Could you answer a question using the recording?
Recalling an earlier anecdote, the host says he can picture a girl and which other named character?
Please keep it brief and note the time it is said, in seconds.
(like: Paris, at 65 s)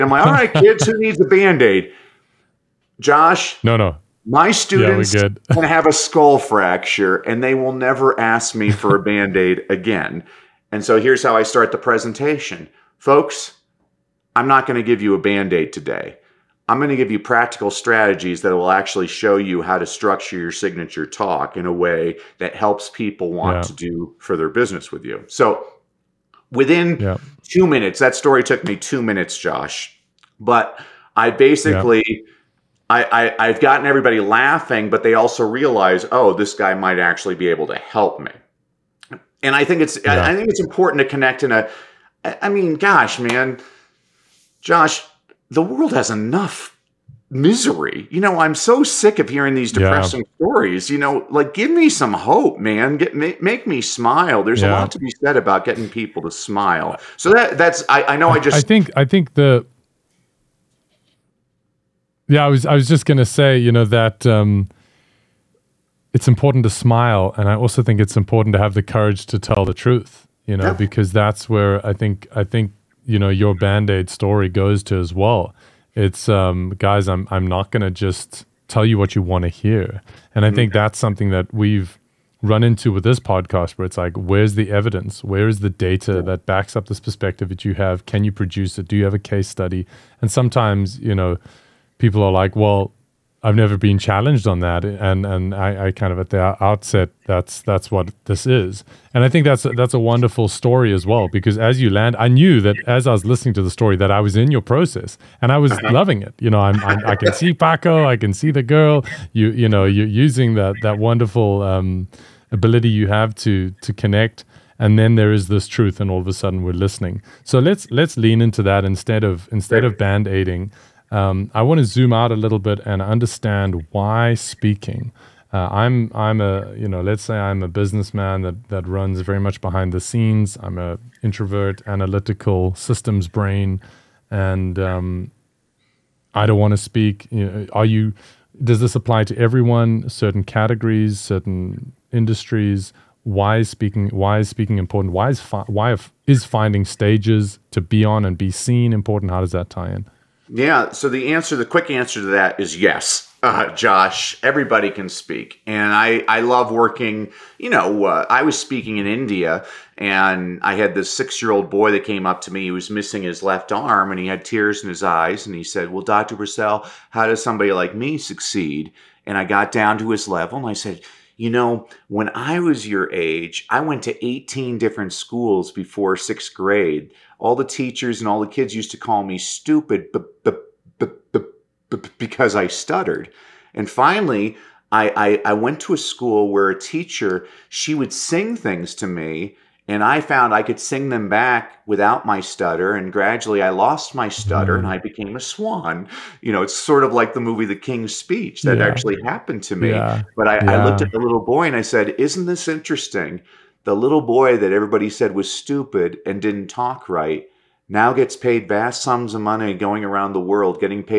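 Paco, at 107 s.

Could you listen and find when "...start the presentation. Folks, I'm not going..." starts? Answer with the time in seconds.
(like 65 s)
11 s.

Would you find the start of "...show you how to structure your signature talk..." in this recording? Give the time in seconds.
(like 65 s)
19 s.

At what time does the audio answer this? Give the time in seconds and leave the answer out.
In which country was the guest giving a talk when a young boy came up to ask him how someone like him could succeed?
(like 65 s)
159 s.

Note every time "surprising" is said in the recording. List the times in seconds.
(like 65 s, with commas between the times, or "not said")
not said.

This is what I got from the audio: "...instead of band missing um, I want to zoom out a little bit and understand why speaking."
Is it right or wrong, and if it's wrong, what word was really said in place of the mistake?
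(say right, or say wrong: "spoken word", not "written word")
wrong: "aiding", not "missing".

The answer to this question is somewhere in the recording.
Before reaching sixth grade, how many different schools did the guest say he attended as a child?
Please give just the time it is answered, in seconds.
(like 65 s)
174 s.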